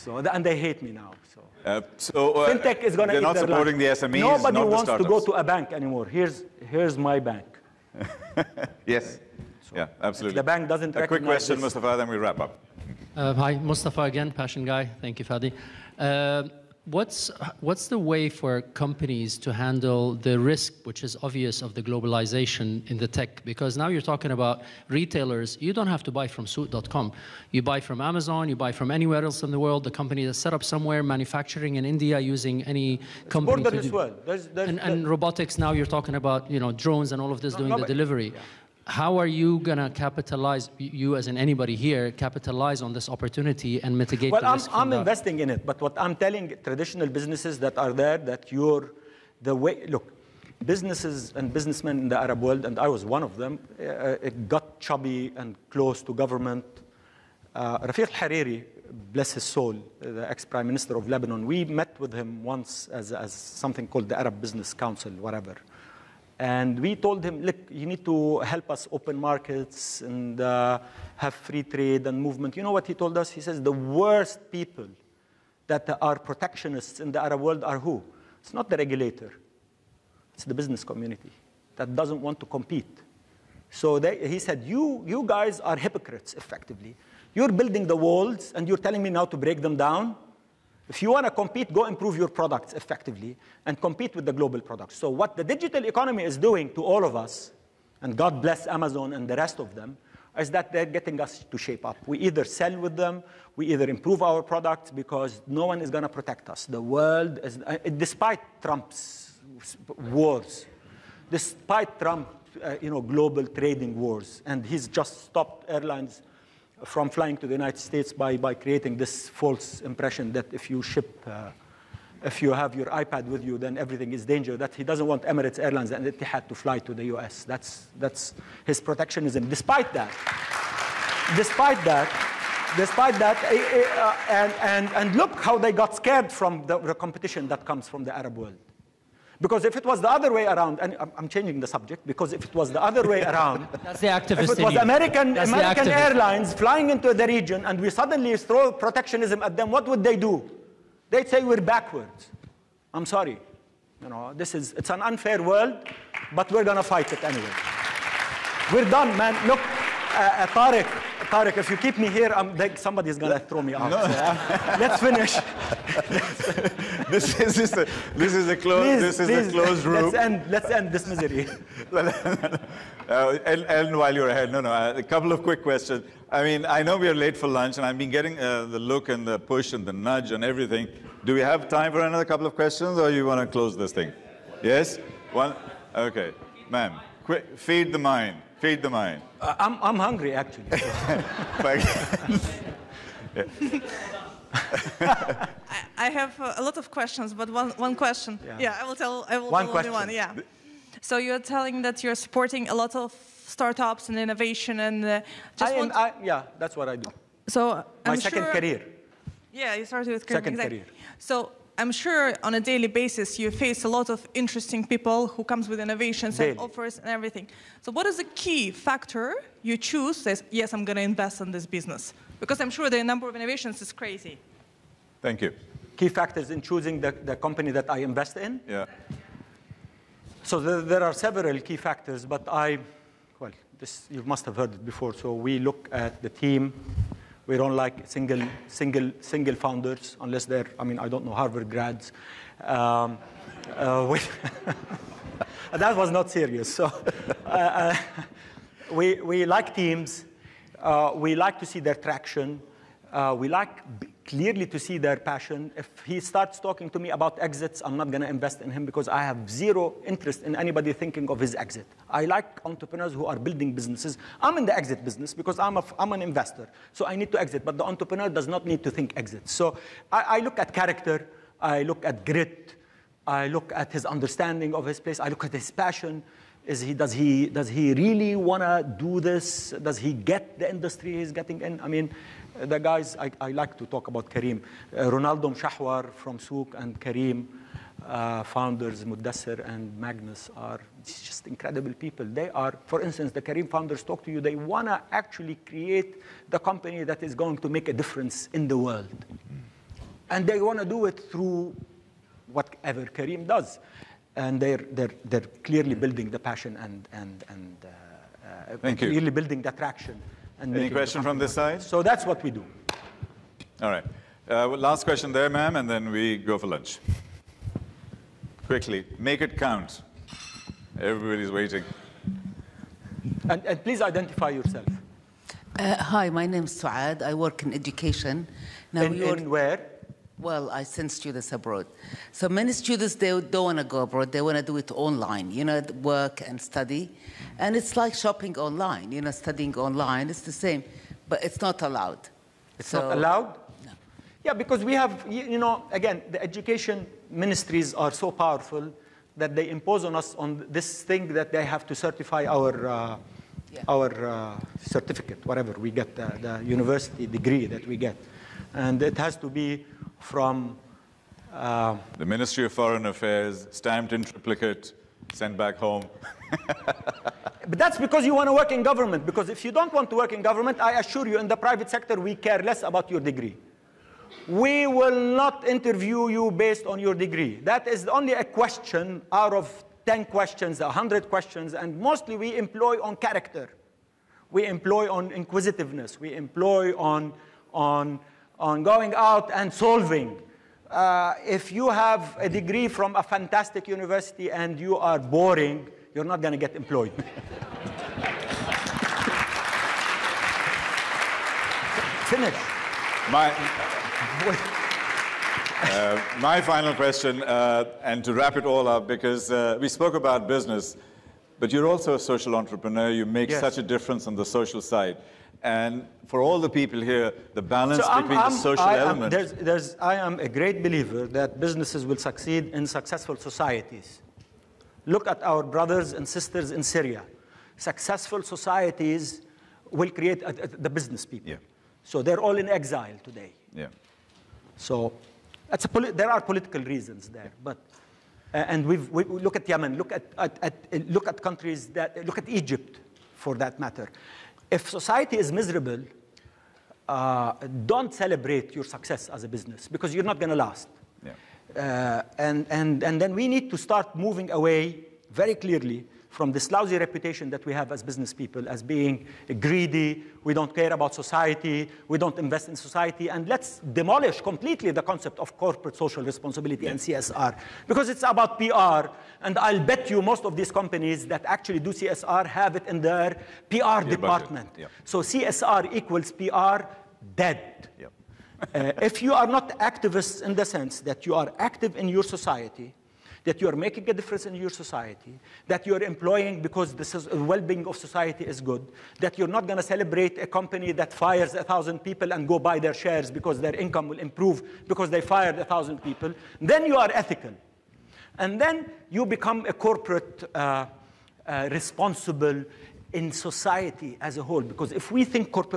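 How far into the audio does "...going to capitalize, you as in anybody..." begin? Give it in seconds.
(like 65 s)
39 s.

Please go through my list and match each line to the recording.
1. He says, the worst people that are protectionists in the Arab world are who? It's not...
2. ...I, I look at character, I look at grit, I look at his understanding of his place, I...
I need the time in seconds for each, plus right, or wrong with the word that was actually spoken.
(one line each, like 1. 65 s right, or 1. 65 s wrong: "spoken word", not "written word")
1. 73 s right
2. 270 s right.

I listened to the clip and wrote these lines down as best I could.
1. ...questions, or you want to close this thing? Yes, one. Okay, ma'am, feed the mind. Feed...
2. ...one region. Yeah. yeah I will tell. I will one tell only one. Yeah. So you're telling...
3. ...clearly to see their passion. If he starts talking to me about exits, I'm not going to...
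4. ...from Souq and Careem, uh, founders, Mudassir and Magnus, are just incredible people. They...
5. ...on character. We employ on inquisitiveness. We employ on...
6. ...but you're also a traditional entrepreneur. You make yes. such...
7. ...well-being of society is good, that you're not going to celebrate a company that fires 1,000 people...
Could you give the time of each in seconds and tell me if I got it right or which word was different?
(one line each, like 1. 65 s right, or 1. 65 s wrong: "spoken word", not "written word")
1. 182 s right
2. 197 s wrong: "question", not "region"
3. 254 s right
4. 286 s right
5. 383 s right
6. 411 s wrong: "social", not "traditional"
7. 487 s right.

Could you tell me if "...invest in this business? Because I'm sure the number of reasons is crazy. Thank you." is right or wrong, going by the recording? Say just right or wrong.
wrong.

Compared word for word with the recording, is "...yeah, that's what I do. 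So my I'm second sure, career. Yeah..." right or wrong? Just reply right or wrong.
right.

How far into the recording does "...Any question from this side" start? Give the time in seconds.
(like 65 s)
310 s.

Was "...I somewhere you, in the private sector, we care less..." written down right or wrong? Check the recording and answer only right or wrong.
wrong.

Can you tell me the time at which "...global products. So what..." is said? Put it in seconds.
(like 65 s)
94 s.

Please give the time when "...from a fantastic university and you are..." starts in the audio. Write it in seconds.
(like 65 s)
392 s.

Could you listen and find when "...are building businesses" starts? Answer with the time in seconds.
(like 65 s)
263 s.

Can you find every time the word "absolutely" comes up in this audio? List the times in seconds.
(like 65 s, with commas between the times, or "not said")
10 s.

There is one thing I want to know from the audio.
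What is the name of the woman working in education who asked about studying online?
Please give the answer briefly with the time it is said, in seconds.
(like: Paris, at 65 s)
Suad, at 326 s.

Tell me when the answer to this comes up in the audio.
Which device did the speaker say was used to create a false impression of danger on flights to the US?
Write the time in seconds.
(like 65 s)
122 s.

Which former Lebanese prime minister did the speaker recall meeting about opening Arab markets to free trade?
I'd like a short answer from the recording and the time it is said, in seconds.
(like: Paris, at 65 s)
Rafiq Hariri, at 57 s.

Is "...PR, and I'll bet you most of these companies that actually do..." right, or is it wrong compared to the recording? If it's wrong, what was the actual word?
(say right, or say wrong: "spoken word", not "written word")
right.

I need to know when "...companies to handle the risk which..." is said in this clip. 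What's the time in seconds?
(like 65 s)
18 s.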